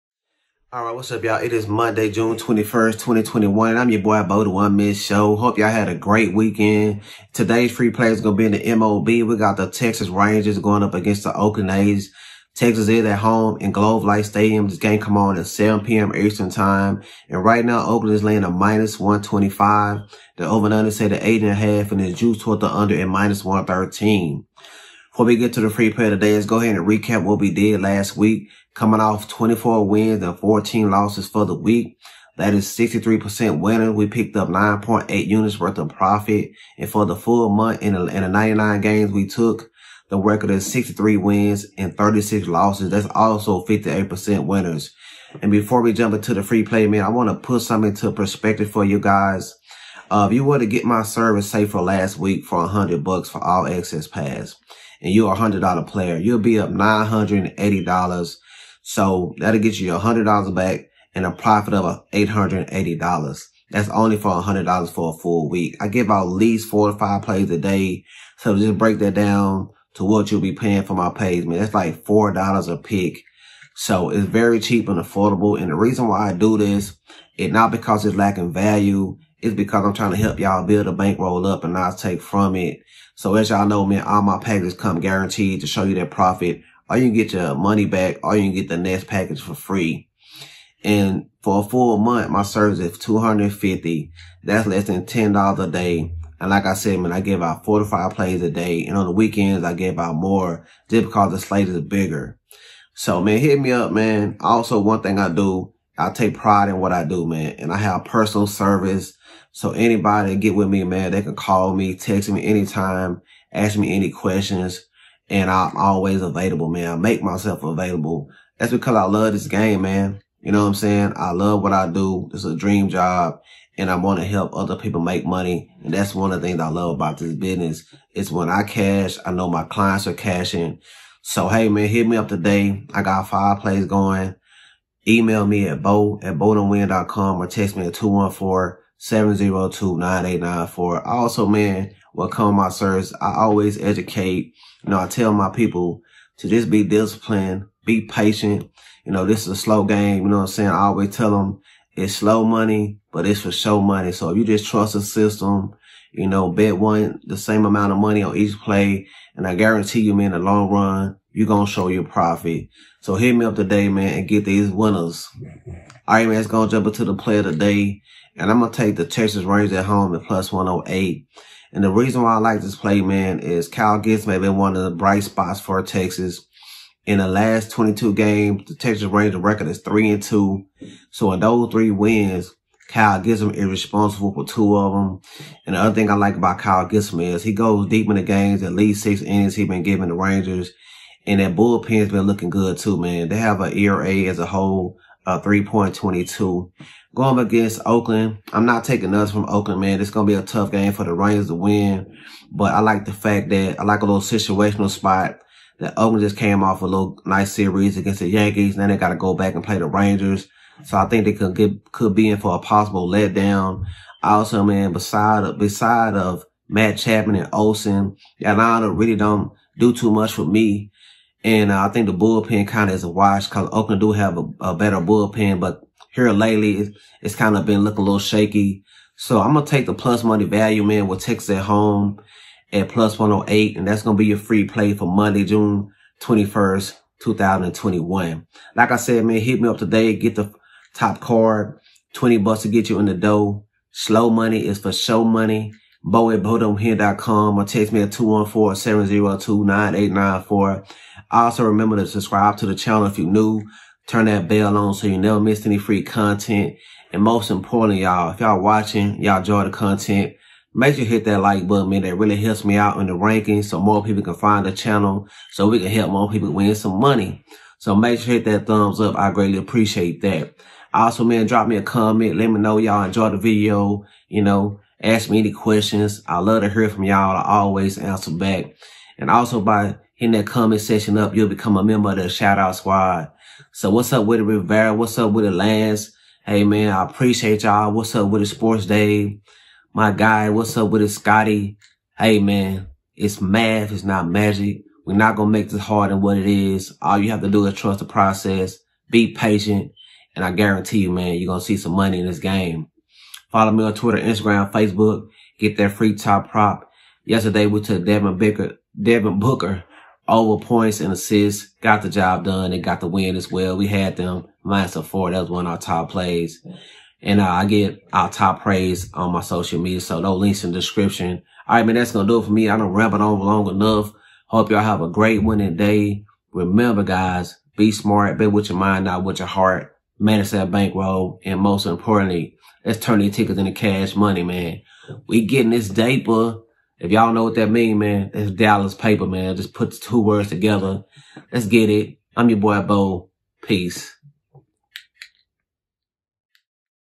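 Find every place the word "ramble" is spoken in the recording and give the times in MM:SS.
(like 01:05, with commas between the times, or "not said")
05:22.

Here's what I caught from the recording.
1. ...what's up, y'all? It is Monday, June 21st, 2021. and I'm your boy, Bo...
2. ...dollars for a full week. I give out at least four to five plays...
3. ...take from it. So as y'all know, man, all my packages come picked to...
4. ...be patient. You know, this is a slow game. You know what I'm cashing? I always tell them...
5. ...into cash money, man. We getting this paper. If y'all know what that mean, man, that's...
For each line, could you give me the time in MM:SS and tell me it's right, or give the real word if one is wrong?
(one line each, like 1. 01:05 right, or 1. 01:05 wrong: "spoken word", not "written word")
1. 00:00 right
2. 01:04 right
3. 01:21 wrong: "guaranteed", not "picked"
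4. 02:27 wrong: "saying", not "cashing"
5. 05:33 right.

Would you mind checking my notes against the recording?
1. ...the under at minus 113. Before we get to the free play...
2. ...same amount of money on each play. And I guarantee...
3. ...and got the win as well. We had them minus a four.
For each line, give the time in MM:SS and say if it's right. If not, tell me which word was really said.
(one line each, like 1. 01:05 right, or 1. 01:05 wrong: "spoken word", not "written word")
1. 00:22 right
2. 02:37 right
3. 05:12 right.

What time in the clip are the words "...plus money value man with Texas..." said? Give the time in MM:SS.
03:49.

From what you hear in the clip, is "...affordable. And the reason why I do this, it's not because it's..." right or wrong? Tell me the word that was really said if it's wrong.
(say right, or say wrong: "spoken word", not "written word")
right.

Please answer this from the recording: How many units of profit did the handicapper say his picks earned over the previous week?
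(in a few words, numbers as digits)
9.8 units.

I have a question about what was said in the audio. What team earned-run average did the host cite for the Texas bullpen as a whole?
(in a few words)
3.22.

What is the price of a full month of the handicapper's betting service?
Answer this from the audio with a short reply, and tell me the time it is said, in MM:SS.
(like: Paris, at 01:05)
$250, at 01:32.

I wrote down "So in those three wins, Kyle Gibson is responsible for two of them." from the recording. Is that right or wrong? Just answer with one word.
right.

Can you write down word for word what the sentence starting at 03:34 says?
Also, man, beside of beside of Matt Chapman and Olson, Atlanta really don't do too much for me.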